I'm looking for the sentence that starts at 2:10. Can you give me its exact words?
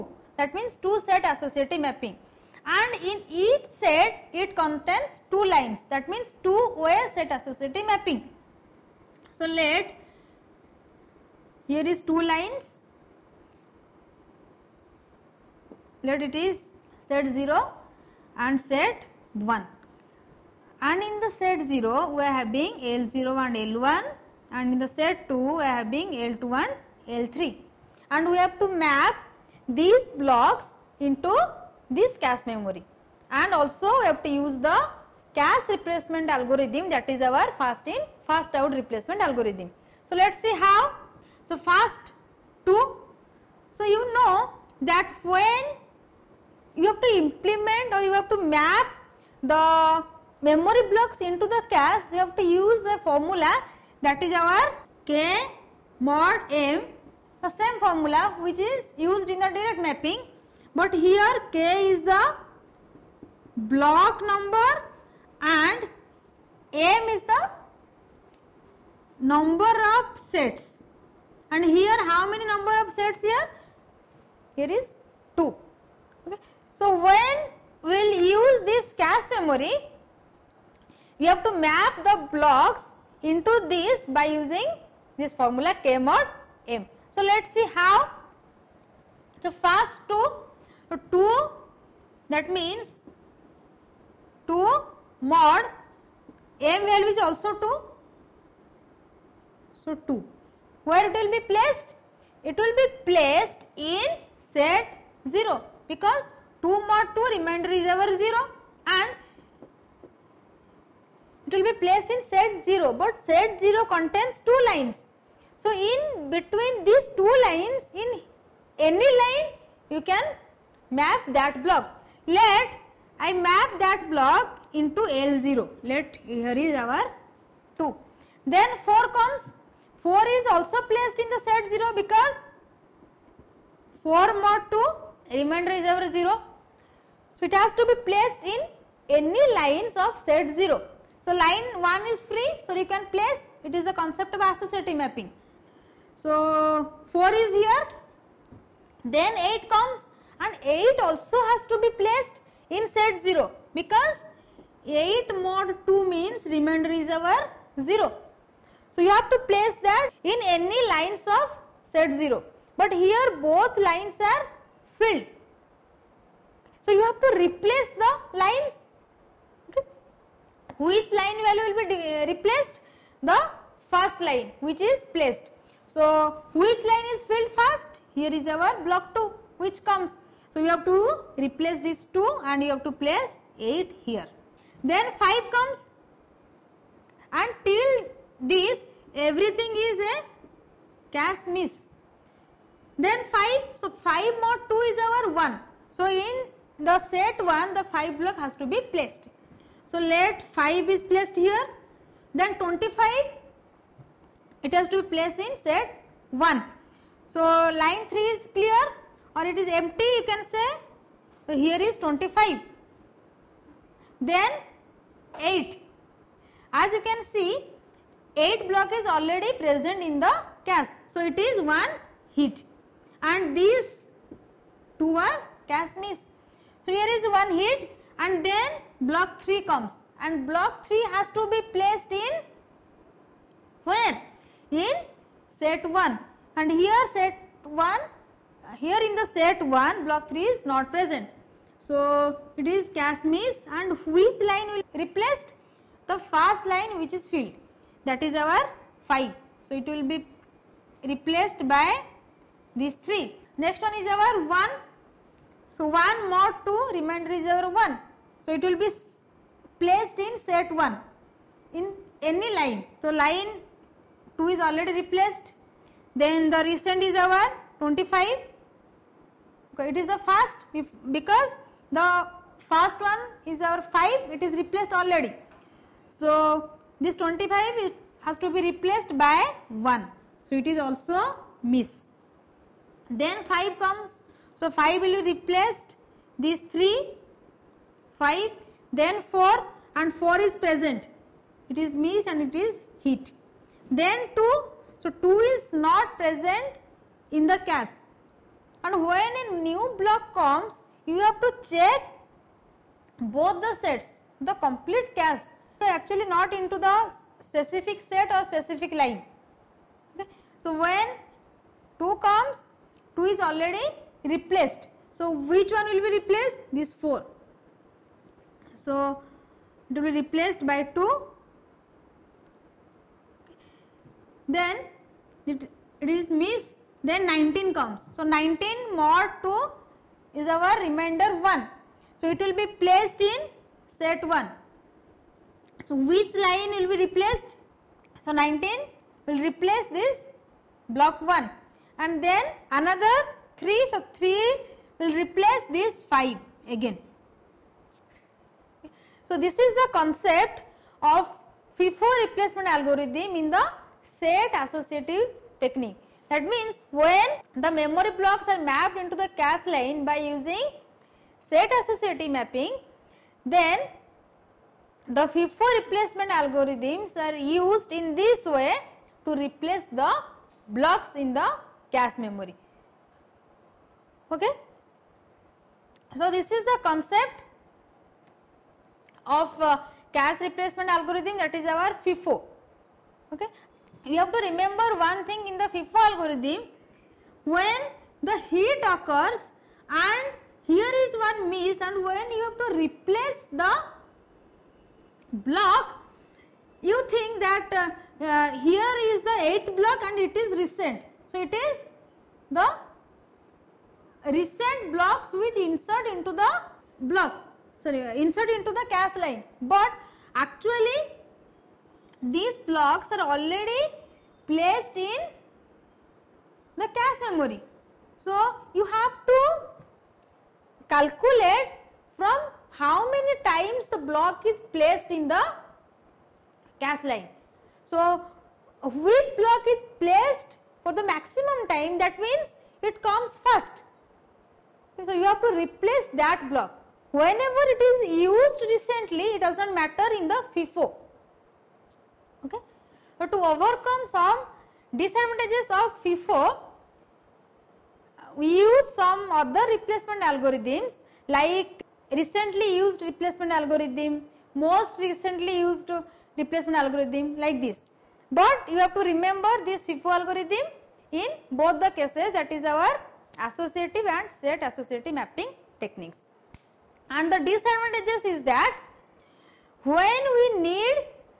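4 is also placed in the set 0 because 4 mod 2 remainder is ever 0.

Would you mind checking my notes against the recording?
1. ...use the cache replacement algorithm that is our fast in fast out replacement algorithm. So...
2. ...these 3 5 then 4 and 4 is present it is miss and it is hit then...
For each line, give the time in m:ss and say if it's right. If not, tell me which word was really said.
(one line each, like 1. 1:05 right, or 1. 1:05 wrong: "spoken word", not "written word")
1. 0:34 right
2. 4:46 right.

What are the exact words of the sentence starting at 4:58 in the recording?
And when a new block comes, you have to check both the sets, the complete cache.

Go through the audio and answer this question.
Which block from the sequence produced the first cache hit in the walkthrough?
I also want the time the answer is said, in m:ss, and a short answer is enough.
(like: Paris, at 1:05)
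8, at 3:38.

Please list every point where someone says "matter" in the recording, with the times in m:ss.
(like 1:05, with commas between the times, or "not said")
7:19.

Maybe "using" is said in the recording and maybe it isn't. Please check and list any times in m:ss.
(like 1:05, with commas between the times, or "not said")
1:24, 6:00.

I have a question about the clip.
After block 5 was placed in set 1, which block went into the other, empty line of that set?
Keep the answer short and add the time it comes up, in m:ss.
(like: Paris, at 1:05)
25, at 3:22.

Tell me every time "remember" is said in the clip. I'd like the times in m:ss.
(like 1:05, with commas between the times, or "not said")
6:24, 7:39.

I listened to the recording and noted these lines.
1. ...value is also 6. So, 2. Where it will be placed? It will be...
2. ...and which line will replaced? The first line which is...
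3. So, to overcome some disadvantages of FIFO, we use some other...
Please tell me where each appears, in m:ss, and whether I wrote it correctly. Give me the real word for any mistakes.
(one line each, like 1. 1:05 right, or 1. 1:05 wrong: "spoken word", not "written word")
1. 1:36 wrong: "2", not "6"
2. 4:03 right
3. 7:23 right.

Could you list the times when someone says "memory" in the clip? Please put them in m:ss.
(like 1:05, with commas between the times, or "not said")
0:32, 0:50, 1:19, 5:57, 6:12, 6:57.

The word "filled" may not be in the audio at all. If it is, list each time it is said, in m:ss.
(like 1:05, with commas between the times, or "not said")
2:44, 2:57, 4:07.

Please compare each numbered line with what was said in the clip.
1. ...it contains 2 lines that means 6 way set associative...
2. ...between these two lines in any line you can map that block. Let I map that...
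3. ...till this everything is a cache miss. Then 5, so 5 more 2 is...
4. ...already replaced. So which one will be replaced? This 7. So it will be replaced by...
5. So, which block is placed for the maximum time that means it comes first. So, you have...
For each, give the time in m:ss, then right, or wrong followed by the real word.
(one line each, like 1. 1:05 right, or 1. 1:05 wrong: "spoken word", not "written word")
1. 0:04 wrong: "2", not "6"
2. 1:56 right
3. 3:07 right
4. 5:13 wrong: "4", not "7"
5. 7:07 right.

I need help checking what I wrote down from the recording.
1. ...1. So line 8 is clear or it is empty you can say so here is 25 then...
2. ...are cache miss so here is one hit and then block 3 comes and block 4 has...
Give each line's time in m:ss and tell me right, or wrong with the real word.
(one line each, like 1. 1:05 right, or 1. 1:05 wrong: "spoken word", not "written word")
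1. 3:26 wrong: "3", not "8"
2. 3:45 wrong: "3", not "4".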